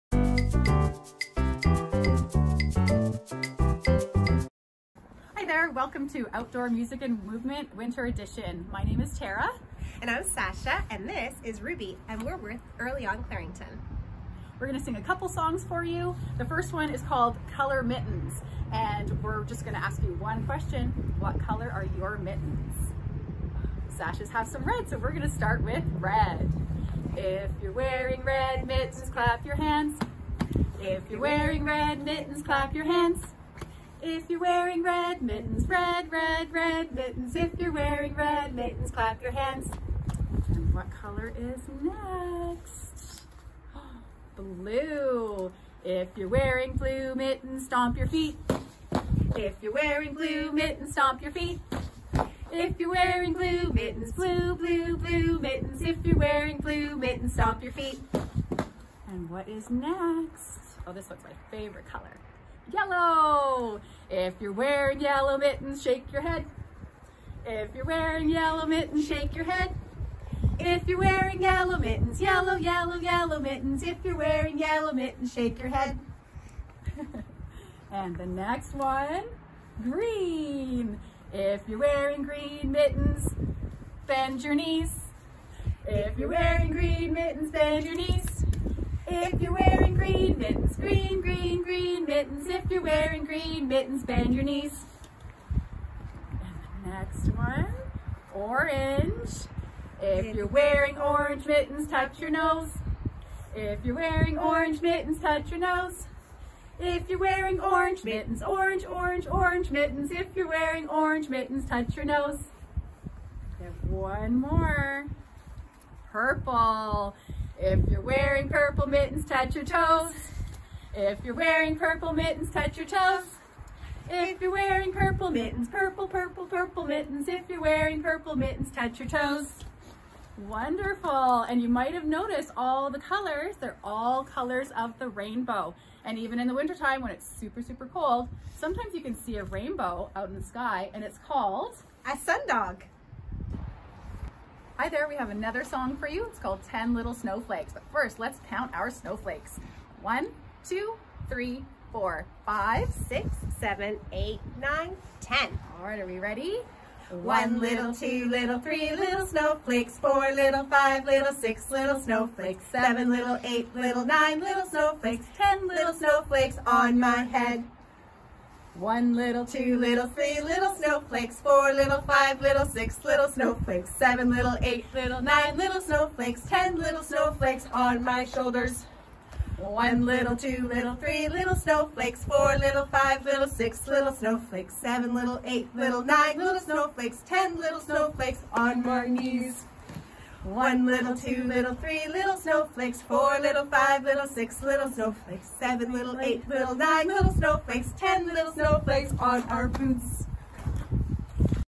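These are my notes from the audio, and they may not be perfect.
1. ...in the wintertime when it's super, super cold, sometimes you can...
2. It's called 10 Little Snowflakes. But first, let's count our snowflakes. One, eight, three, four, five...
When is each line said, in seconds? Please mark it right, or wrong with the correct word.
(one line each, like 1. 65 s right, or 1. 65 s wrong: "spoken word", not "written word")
1. 136 s right
2. 146 s wrong: "two", not "eight".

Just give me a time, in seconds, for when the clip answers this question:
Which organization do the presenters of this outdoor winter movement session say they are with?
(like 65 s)
12 s.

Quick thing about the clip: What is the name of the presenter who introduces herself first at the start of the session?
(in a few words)
Tara.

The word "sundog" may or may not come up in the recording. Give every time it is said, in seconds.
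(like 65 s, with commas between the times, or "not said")
142 s.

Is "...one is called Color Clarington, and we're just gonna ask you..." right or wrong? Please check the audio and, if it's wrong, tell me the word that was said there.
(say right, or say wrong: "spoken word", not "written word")
wrong: "Mittens", not "Clarington".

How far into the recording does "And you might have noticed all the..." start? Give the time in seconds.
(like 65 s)
131 s.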